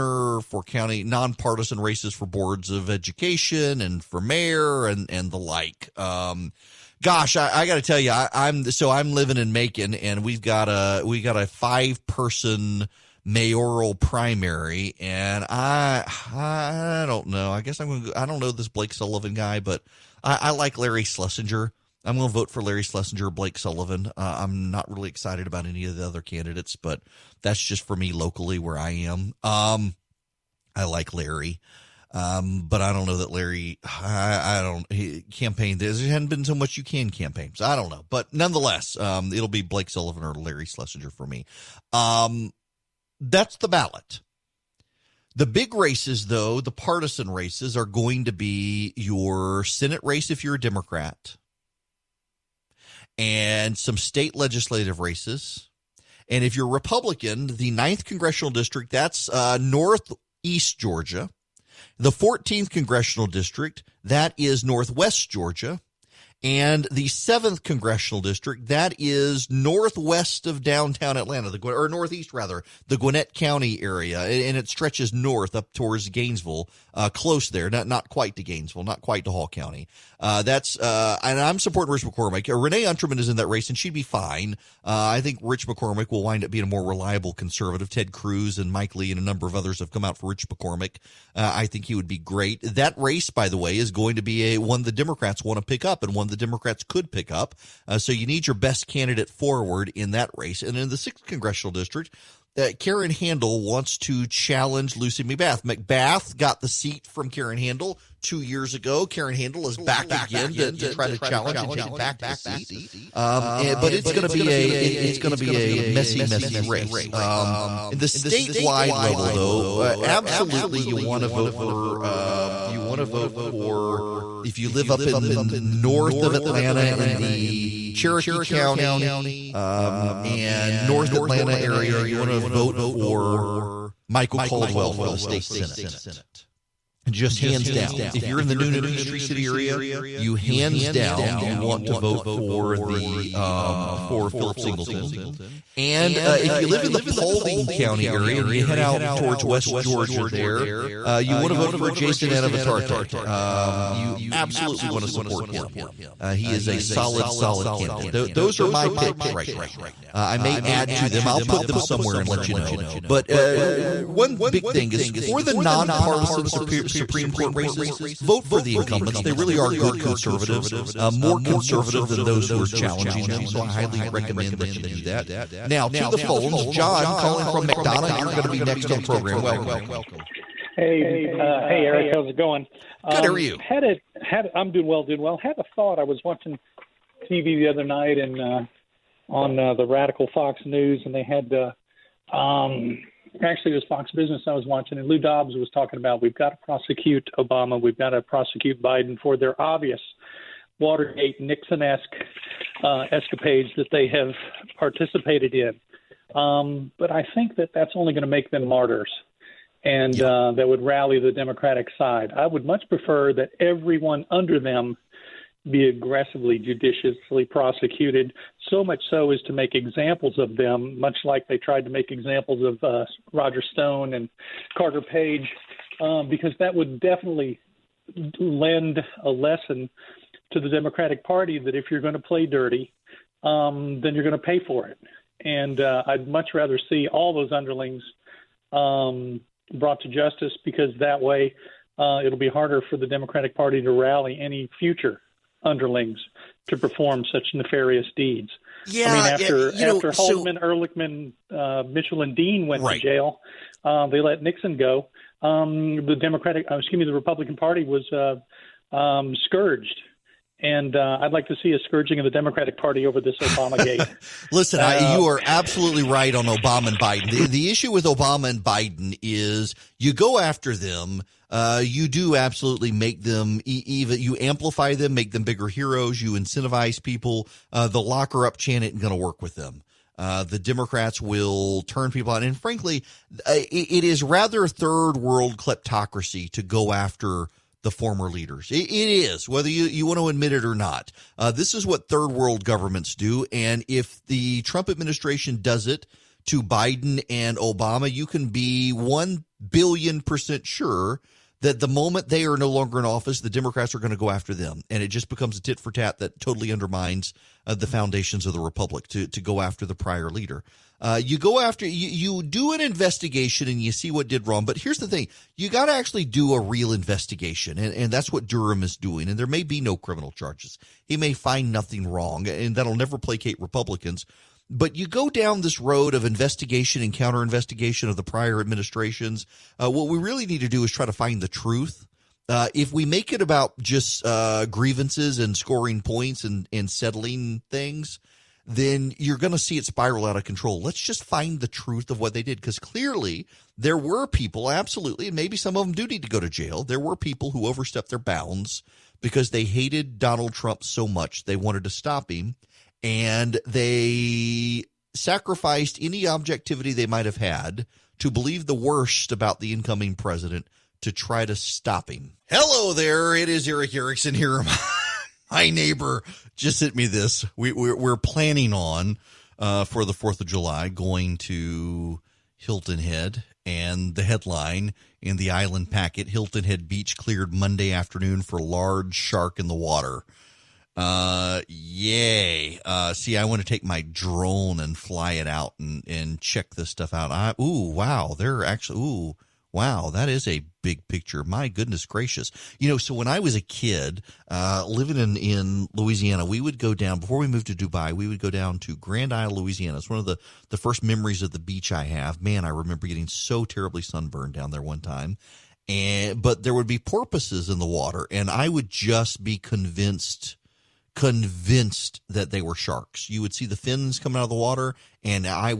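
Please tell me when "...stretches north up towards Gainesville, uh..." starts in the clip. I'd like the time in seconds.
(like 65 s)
74 s.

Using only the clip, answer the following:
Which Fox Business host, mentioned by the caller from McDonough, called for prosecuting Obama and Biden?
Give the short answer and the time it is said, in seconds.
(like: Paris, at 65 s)
Lou Dobbs, at 195 s.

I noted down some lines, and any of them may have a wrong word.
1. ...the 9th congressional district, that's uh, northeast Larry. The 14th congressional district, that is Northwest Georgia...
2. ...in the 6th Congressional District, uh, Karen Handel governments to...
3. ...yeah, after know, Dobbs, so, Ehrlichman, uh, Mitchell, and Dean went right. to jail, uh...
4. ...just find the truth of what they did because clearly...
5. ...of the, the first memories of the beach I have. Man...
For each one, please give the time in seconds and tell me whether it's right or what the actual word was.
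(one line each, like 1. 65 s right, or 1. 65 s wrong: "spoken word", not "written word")
1. 57 s wrong: "Georgia", not "Larry"
2. 100 s wrong: "wants", not "governments"
3. 249 s wrong: "Haldeman", not "Dobbs"
4. 340 s right
5. 400 s right.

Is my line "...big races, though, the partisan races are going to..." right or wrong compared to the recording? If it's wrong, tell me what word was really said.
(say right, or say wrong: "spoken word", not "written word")
right.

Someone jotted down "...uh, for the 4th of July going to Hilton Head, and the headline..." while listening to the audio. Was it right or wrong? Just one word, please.
right.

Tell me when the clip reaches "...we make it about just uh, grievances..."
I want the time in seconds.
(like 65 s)
332 s.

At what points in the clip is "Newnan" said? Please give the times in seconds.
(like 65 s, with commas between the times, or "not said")
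138 s.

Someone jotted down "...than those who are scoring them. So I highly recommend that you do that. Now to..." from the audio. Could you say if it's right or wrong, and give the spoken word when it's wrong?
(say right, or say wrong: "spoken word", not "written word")
wrong: "challenging", not "scoring".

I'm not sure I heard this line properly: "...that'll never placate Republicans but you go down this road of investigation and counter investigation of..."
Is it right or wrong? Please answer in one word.
right.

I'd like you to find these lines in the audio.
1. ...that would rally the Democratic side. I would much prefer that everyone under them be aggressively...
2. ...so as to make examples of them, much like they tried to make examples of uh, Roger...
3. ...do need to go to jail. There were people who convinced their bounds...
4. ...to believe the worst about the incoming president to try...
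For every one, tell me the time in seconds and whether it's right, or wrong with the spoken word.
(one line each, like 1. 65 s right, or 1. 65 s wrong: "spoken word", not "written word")
1. 210 s right
2. 219 s right
3. 345 s wrong: "overstepped", not "convinced"
4. 358 s right.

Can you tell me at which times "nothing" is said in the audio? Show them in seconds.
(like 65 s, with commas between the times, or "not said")
321 s.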